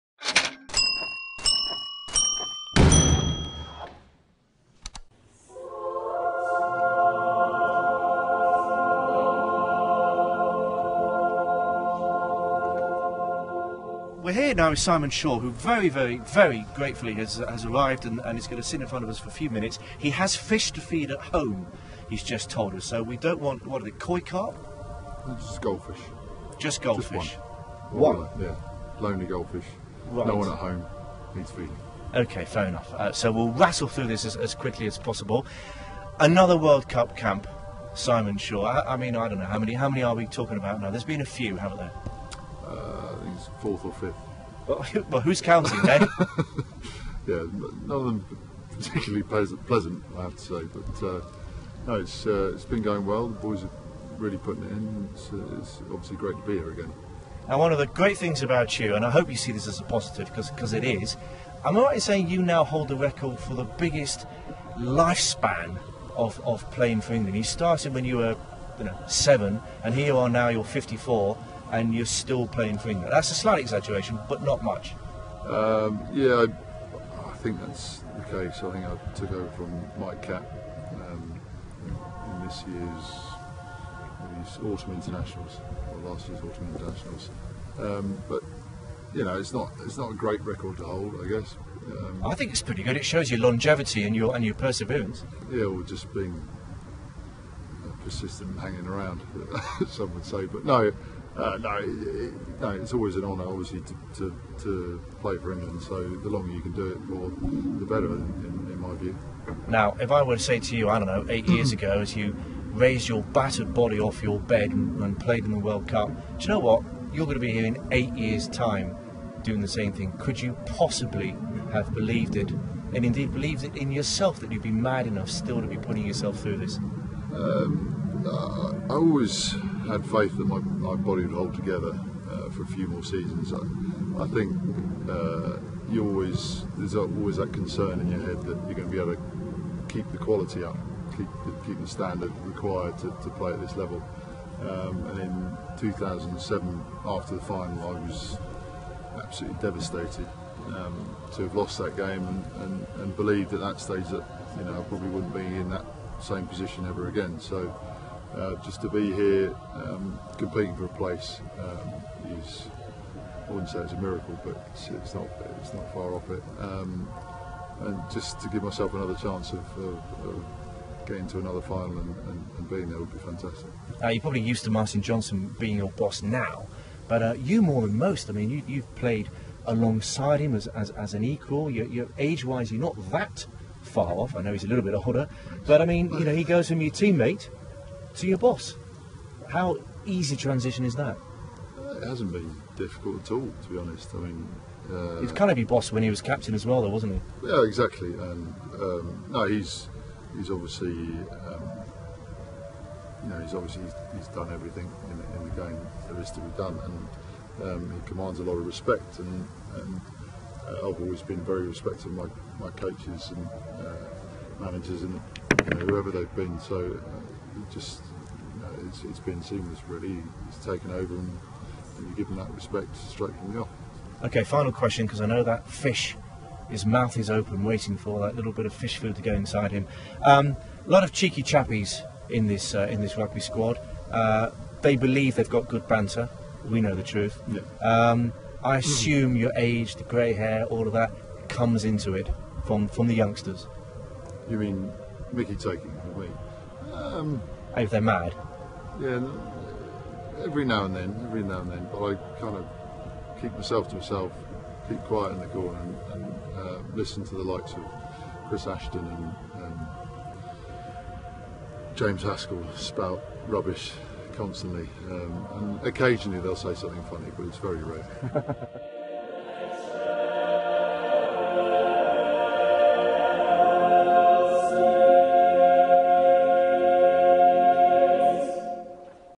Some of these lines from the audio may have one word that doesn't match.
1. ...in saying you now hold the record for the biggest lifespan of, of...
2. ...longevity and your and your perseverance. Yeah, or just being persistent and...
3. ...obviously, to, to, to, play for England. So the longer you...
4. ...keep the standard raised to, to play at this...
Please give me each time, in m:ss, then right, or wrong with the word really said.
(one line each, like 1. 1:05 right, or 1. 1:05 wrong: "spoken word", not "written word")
1. 1:01 right
2. 1:33 right
3. 1:43 right
4. 2:21 wrong: "required", not "raised".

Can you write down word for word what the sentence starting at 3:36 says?
So uh, it just you know, it's, it's been seamless really.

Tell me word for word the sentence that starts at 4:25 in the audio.
Um, and occasionally they'll say something funny, but it's very rare.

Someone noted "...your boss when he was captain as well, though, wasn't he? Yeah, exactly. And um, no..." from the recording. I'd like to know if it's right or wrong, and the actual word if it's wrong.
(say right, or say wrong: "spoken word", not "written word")
right.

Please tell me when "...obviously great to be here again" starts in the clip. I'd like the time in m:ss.
0:55.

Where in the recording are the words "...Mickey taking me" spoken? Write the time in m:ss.
4:05.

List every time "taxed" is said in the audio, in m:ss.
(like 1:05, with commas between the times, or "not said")
not said.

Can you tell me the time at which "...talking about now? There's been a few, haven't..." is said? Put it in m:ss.
0:40.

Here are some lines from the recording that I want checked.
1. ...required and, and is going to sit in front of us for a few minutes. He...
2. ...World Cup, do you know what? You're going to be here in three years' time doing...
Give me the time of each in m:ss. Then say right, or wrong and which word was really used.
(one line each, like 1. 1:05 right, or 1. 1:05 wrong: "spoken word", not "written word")
1. 0:17 wrong: "arrived", not "required"
2. 1:55 wrong: "eight", not "three".